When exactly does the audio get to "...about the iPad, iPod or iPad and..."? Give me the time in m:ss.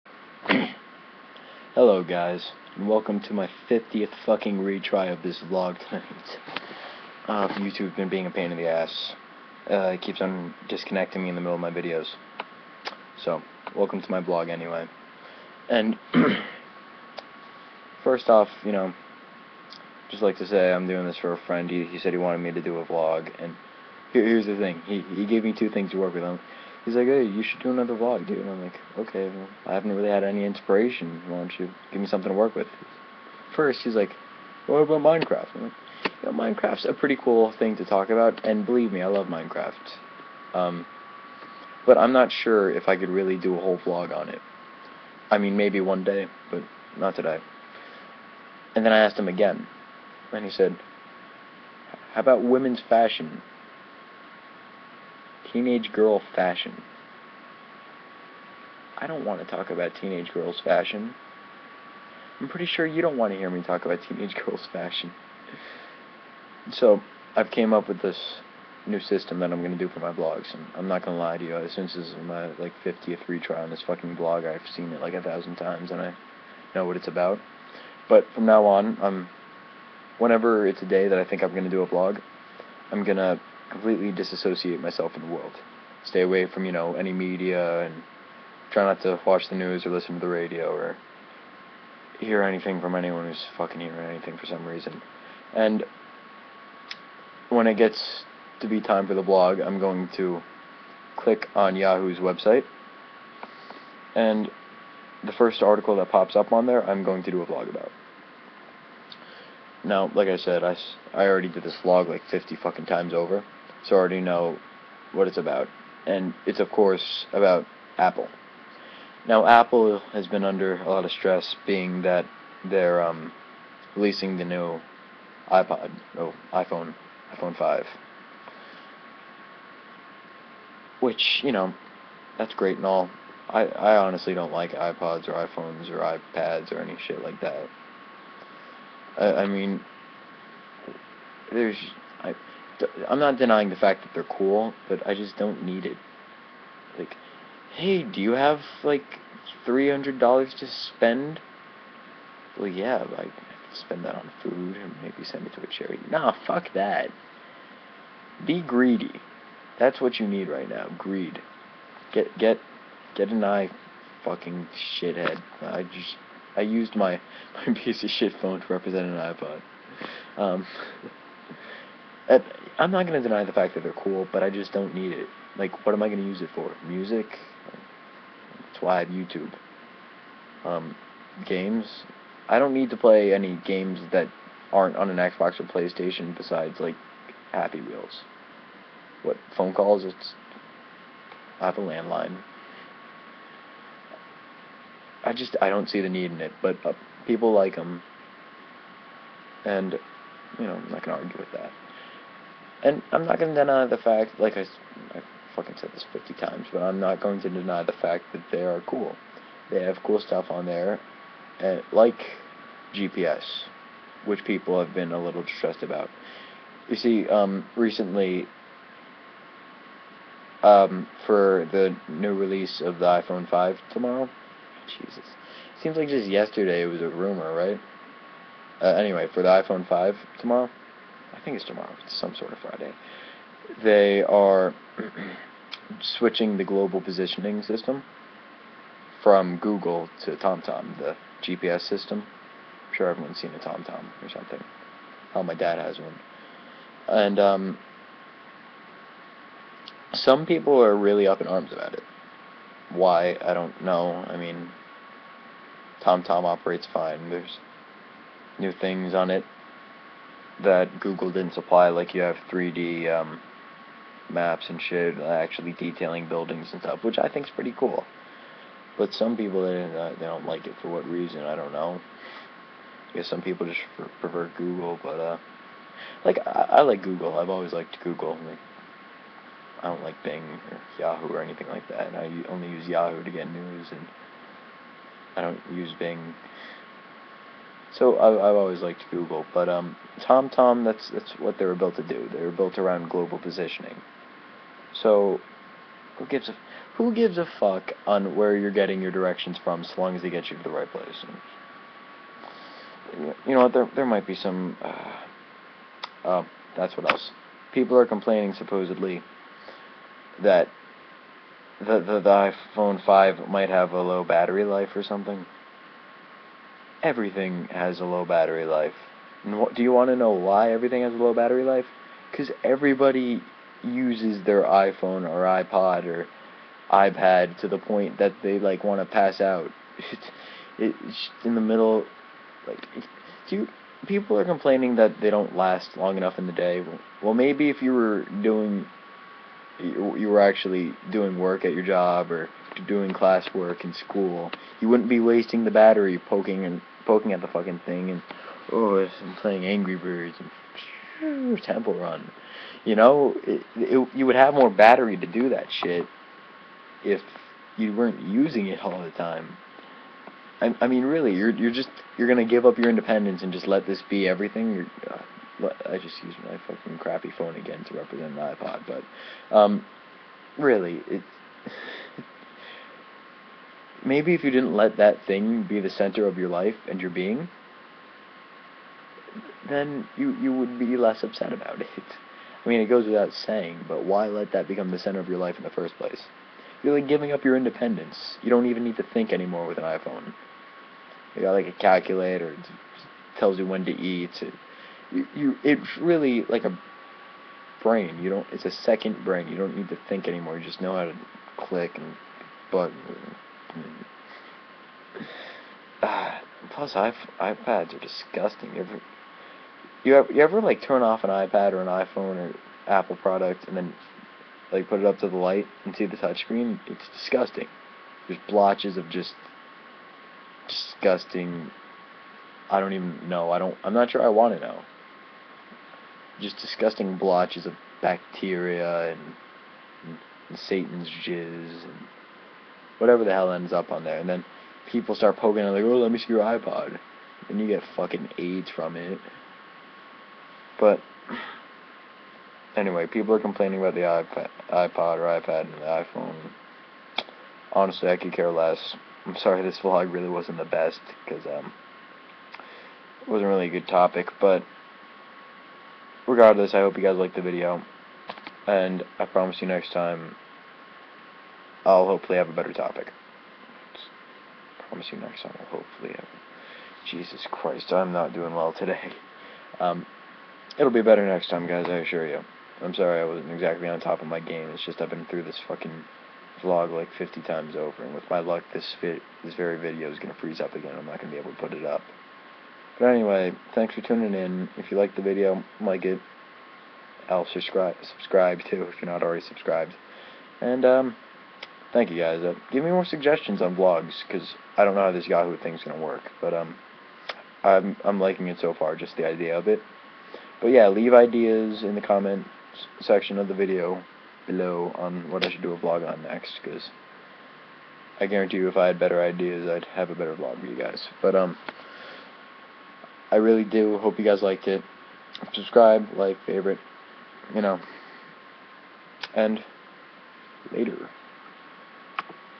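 7:23.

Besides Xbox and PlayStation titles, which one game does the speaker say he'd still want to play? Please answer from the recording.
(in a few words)
Happy Wheels.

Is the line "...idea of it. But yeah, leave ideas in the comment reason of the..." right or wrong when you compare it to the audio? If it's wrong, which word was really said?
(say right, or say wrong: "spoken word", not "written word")
wrong: "section", not "reason".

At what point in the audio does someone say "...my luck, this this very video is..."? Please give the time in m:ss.
7:58.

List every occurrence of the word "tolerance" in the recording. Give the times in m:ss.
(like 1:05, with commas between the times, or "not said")
not said.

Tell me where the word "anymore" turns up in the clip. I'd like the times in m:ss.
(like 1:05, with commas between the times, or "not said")
6:29, 6:40.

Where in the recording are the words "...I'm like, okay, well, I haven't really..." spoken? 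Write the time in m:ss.
0:28.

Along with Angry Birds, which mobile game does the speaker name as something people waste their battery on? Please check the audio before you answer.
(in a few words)
Temple Run.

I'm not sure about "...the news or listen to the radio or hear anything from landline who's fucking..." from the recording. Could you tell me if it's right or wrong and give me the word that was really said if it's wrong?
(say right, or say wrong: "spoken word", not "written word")
wrong: "anyone", not "landline".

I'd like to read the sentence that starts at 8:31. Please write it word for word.
But um, I really do hope you guys liked it.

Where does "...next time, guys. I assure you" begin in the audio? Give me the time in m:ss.
7:51.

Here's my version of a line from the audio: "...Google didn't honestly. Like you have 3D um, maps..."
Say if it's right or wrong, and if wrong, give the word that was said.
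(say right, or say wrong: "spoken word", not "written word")
wrong: "supply", not "honestly".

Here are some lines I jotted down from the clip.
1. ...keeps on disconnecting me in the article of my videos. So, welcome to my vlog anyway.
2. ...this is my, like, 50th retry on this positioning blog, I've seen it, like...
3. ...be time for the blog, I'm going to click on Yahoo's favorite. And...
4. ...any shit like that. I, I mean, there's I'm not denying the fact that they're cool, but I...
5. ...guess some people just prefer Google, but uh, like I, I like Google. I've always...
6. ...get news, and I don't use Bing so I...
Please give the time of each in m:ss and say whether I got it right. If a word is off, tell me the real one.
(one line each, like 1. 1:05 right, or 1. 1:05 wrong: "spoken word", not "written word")
1. 0:10 wrong: "middle", not "article"
2. 1:11 wrong: "fucking", not "positioning"
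3. 1:38 wrong: "website", not "favorite"
4. 2:16 right
5. 4:33 right
6. 4:43 right.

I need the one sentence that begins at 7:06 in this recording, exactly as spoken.
Just disgusting blotches of bacteria and, and, and Satan's jizz and whatever the hell ends up on there.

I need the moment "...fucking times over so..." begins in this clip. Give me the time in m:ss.
1:52.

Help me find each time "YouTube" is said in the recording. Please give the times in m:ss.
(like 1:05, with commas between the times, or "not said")
0:07, 2:59.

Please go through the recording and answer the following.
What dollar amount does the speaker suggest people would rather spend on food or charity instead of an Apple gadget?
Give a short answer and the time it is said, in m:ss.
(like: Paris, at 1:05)
$300, at 2:29.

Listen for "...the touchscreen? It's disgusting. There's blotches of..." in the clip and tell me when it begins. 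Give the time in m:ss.
6:56.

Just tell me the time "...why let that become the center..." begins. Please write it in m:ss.
6:24.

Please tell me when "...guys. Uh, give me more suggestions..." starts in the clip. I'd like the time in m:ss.
8:12.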